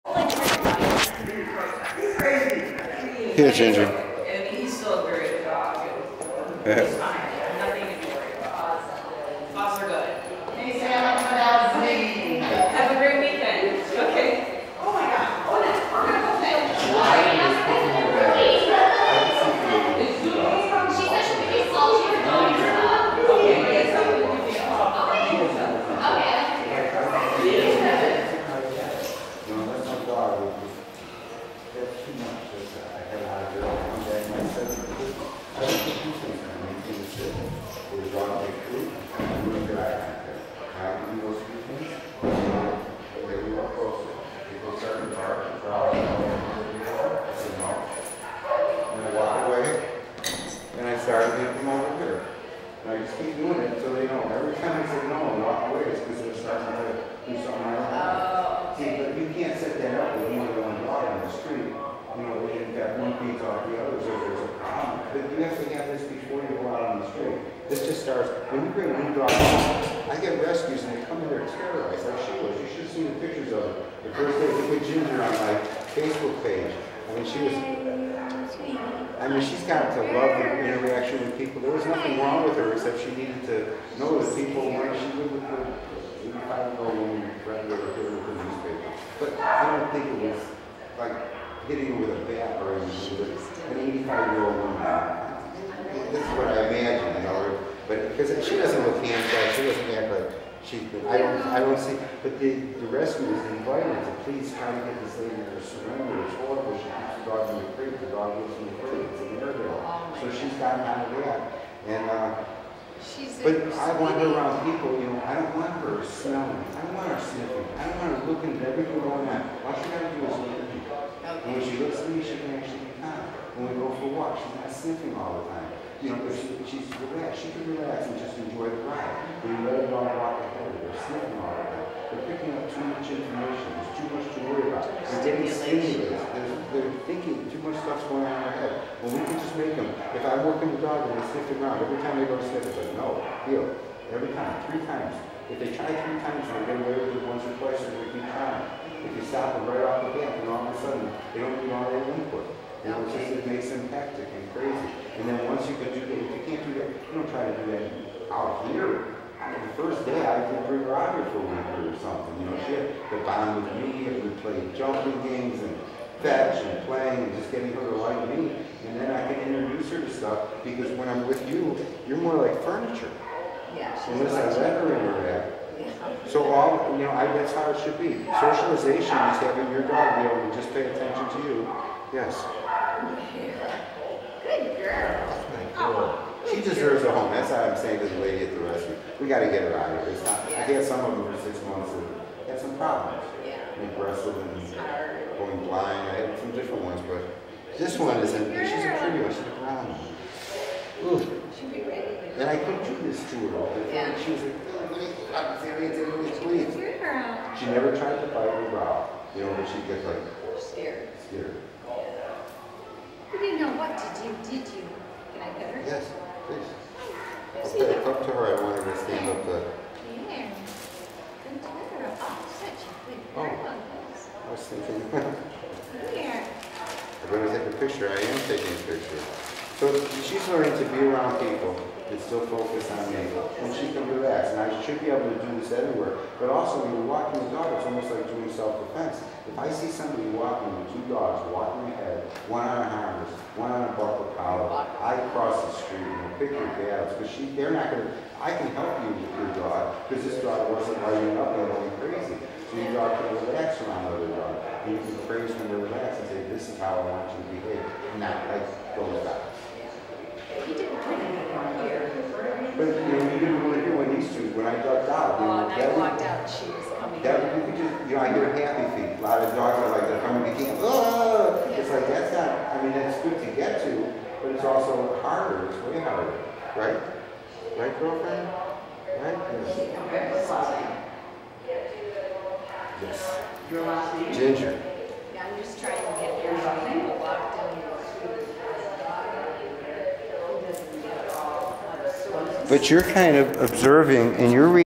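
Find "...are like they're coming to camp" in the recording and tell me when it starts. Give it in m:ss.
4:29.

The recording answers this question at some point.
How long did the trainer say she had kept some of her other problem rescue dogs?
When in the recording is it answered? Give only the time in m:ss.
3:11.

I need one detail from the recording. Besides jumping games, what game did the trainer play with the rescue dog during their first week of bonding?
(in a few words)
Fetch.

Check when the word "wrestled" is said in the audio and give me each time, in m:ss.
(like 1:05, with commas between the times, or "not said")
3:14.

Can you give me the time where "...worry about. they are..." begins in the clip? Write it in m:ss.
2:14.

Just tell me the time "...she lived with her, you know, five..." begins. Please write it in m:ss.
1:24.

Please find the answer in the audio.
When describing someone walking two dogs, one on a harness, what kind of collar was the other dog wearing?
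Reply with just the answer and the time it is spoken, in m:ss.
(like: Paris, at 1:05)
Buckle collar, at 4:03.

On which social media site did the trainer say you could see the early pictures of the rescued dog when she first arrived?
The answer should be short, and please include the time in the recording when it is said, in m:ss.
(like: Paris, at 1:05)
Facebook, at 1:15.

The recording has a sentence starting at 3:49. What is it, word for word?
So she's learning to be around people that still focus on me.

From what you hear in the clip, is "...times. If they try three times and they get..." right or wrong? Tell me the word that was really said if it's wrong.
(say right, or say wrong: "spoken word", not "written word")
right.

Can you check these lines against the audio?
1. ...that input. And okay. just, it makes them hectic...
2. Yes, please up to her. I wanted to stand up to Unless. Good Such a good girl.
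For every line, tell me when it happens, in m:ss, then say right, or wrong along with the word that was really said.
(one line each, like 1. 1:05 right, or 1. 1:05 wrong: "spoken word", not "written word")
1. 2:31 right
2. 3:35 wrong: "Yeah", not "Unless".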